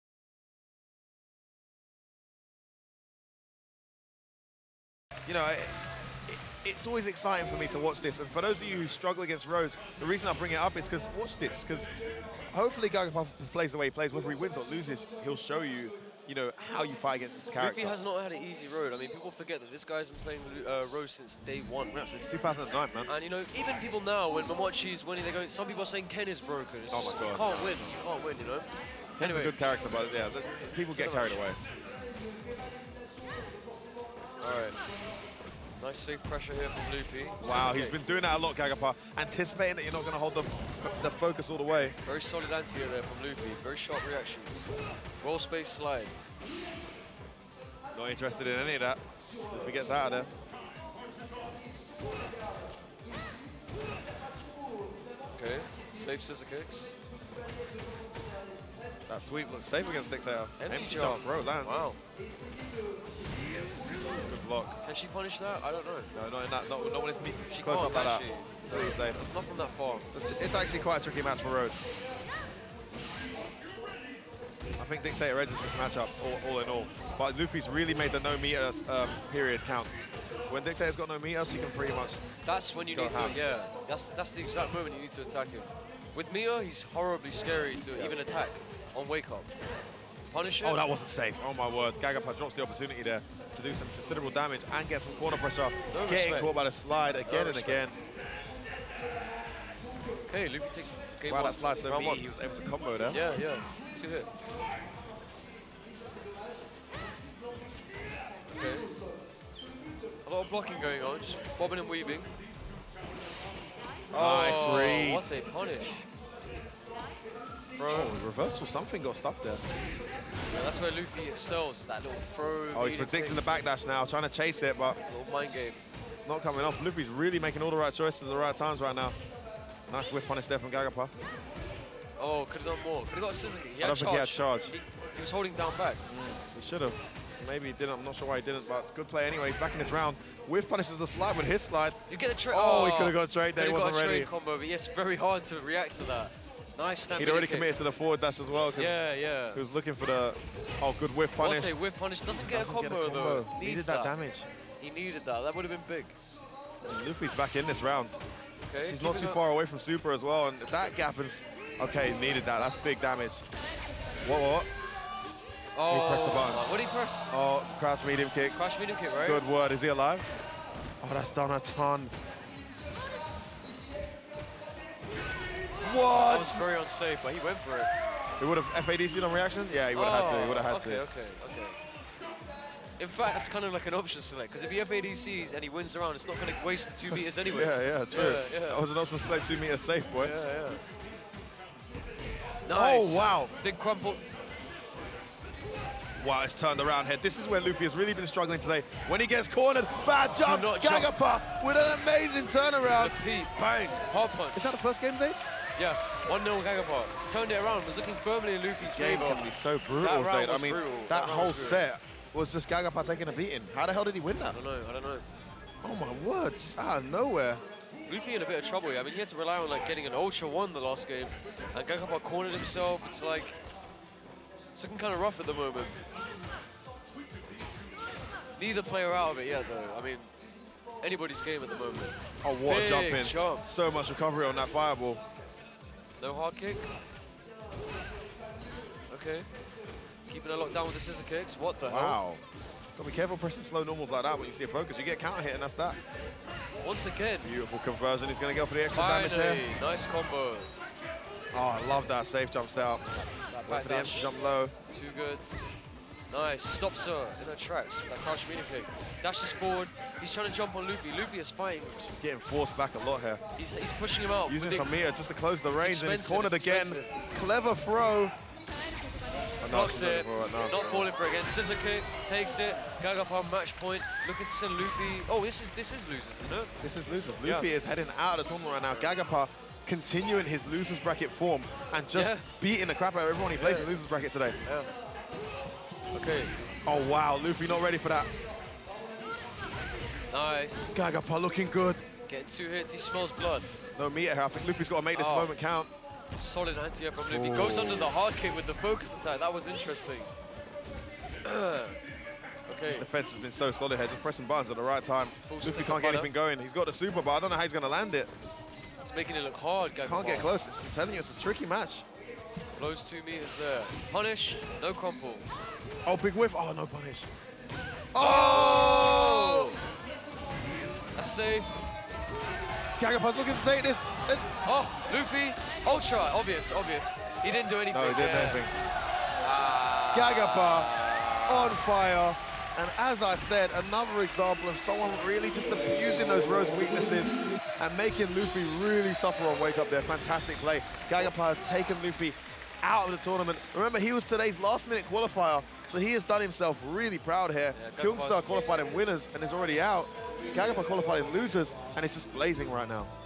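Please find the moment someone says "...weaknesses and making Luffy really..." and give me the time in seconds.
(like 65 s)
336 s.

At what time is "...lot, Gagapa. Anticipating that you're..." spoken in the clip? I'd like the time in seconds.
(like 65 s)
38 s.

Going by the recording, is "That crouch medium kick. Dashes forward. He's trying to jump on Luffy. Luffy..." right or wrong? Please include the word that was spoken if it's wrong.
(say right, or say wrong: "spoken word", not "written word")
right.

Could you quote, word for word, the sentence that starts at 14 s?
Whether he wins or loses, he'll show you you know, how you fight against this character.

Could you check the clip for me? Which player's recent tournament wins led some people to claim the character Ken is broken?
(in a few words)
Momochi.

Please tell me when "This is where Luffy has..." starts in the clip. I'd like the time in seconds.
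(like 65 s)
197 s.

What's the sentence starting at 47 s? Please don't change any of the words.
Not interested in any of that.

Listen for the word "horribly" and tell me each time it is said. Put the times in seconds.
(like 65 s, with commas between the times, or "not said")
86 s.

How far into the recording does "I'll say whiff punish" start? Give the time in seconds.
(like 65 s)
151 s.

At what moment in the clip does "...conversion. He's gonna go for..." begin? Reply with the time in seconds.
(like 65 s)
247 s.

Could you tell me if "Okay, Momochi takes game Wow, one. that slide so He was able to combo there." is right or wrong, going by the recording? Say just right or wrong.
wrong.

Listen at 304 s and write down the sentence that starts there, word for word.
Just pressing buttons at the right time.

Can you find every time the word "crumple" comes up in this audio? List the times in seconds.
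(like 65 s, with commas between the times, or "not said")
193 s, 314 s.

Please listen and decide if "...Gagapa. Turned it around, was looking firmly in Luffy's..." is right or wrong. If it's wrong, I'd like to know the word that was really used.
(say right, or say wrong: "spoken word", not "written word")
right.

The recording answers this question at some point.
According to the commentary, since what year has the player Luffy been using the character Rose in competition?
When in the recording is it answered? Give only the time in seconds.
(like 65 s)
22 s.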